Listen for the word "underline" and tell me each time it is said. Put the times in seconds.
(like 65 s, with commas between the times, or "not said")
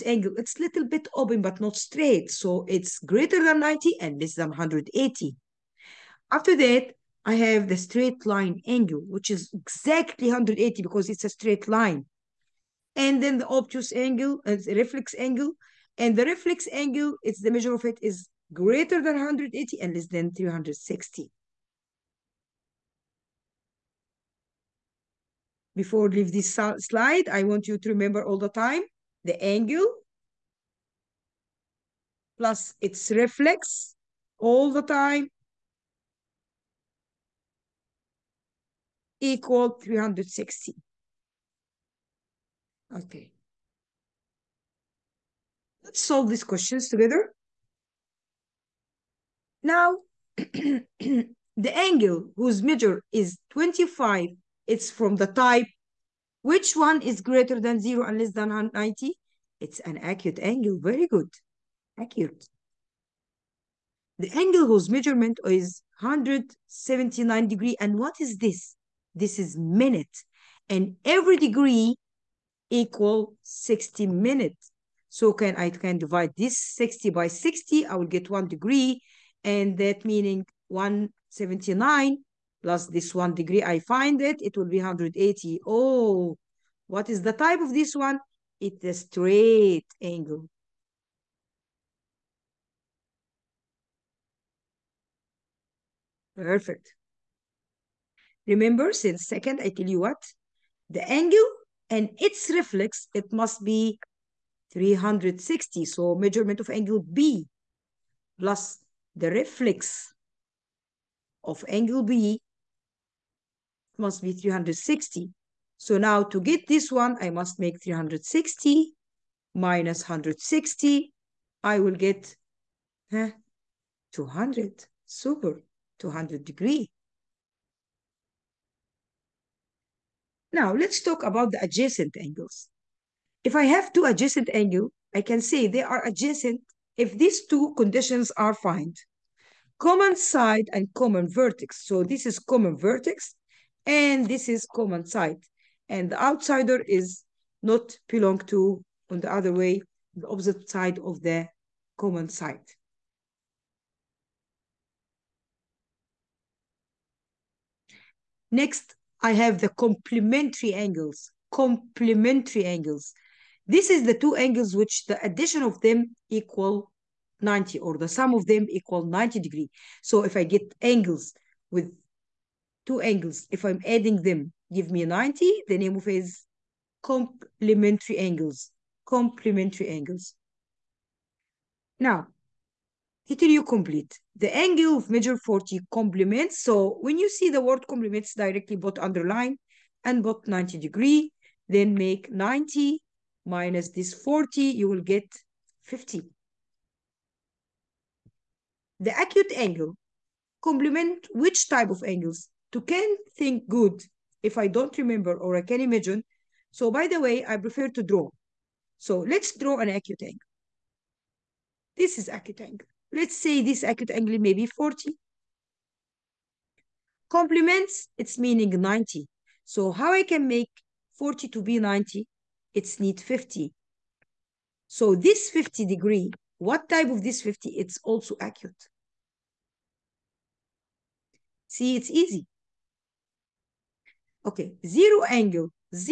188 s.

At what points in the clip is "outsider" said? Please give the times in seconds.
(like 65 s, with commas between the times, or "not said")
146 s.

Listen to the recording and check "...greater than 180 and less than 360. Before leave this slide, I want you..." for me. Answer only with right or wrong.
right.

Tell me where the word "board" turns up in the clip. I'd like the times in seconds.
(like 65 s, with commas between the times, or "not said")
not said.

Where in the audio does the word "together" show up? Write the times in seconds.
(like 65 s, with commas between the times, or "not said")
46 s.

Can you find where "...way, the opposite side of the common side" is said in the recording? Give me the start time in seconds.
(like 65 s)
149 s.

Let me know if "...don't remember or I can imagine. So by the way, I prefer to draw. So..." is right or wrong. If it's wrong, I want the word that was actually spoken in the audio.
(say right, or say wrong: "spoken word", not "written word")
right.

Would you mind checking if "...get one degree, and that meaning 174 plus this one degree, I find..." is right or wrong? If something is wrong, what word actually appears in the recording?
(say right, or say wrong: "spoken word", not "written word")
wrong: "179", not "174".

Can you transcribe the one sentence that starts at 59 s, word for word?
It's an acute angle, very good, accurate.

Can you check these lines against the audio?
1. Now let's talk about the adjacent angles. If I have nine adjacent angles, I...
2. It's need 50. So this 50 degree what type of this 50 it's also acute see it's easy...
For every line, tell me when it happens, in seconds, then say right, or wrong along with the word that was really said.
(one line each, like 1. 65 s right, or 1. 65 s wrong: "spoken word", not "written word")
1. 130 s wrong: "two", not "nine"
2. 222 s right.